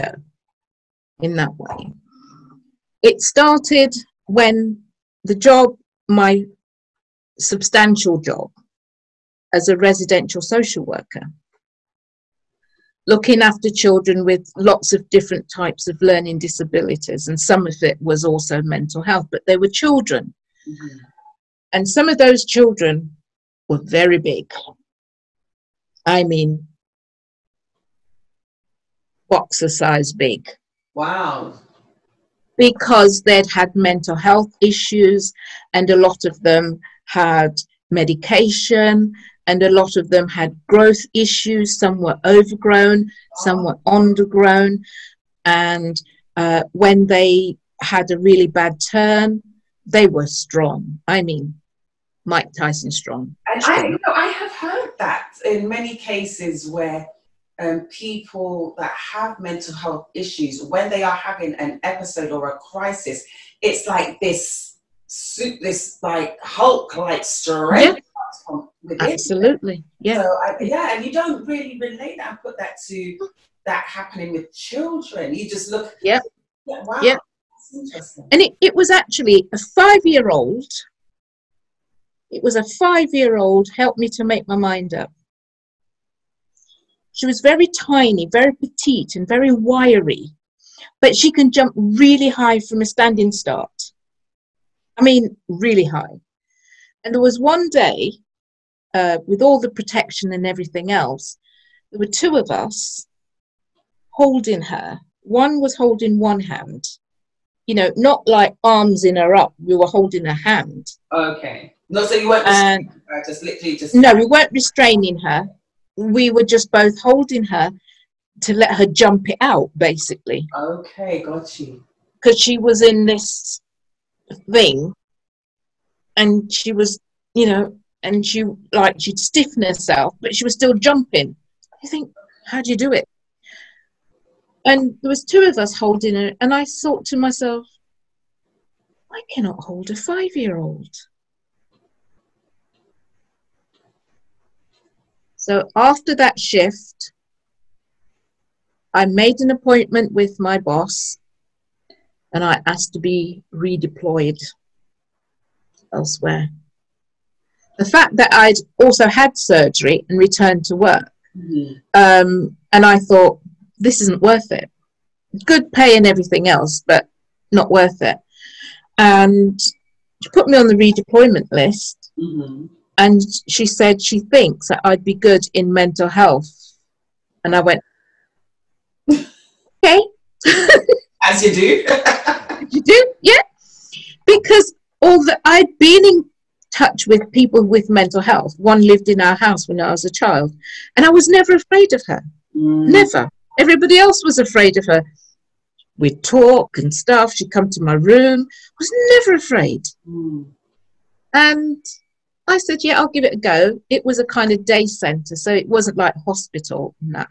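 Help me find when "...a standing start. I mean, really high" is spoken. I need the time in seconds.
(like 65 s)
92 s.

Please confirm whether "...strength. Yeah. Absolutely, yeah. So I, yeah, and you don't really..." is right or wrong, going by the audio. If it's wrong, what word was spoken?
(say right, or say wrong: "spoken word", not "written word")
right.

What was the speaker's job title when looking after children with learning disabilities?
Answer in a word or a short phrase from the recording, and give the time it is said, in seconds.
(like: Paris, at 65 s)
Residential social worker, at 9 s.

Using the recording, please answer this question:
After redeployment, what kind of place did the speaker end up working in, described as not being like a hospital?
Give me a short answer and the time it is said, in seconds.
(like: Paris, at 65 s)
Day centre, at 204 s.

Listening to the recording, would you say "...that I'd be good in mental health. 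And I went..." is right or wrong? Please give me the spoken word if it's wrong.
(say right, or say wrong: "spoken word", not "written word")
right.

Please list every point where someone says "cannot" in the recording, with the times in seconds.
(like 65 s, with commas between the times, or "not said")
139 s.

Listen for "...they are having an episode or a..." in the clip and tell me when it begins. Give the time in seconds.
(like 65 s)
60 s.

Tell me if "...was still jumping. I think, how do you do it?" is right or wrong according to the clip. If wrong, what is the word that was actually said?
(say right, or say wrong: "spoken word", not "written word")
right.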